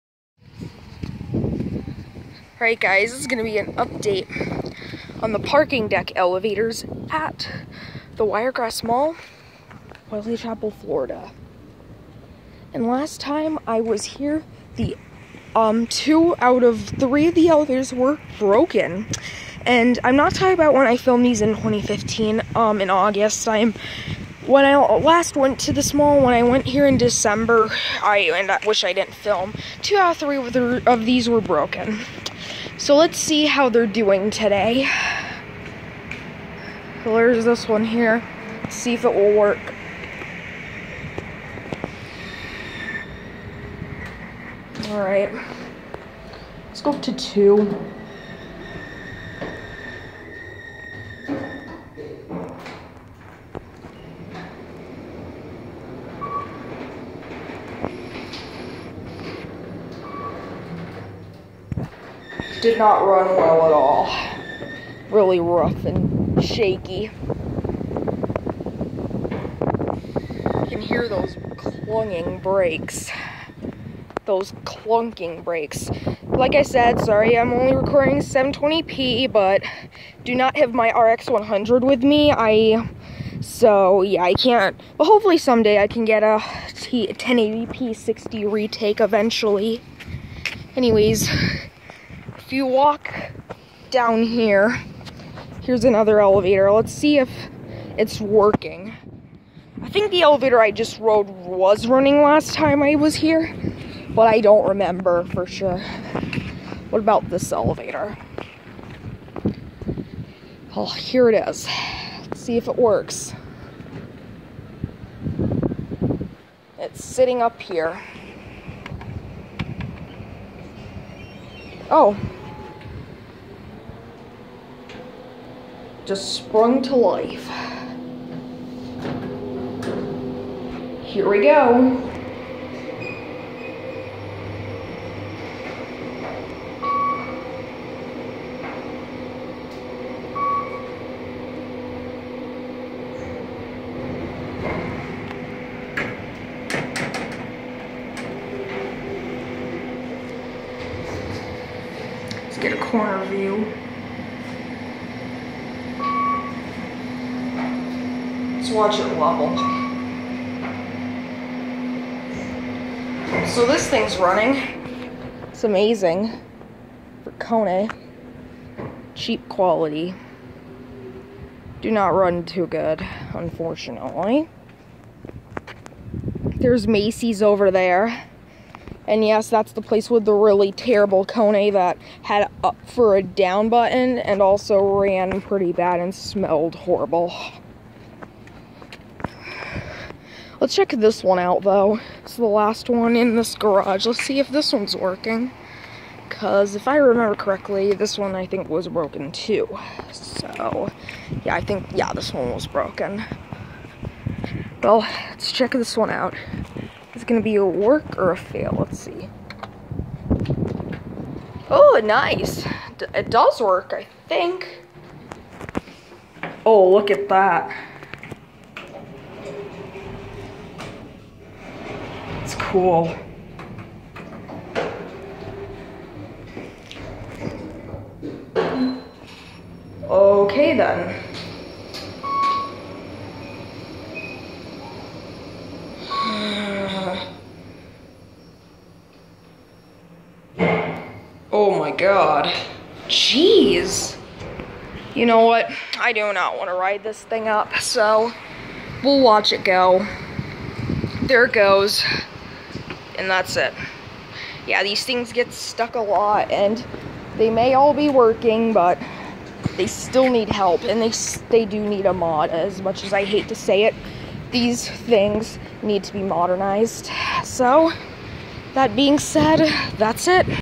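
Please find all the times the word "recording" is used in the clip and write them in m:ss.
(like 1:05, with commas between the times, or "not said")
1:17.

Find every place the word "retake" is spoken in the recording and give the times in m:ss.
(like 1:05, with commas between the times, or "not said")
1:28.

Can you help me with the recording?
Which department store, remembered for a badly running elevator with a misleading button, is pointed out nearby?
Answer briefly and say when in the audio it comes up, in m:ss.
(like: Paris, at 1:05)
Macy's, at 2:56.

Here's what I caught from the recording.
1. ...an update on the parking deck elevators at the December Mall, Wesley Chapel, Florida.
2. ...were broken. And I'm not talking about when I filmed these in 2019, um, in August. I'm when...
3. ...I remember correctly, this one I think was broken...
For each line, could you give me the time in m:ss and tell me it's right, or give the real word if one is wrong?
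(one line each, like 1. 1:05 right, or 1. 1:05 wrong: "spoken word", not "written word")
1. 0:03 wrong: "Wiregrass", not "December"
2. 0:17 wrong: "2015", not "2019"
3. 3:16 right.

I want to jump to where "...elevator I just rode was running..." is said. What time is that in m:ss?
1:40.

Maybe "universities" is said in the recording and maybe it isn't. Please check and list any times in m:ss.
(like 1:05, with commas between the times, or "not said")
not said.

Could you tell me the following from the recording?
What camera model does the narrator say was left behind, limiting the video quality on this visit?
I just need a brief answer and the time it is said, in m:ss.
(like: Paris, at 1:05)
RX100, at 1:20.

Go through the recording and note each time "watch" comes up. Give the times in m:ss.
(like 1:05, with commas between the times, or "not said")
2:38, 4:09.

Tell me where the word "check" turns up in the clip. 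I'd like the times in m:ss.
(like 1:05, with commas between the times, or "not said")
3:10, 3:25.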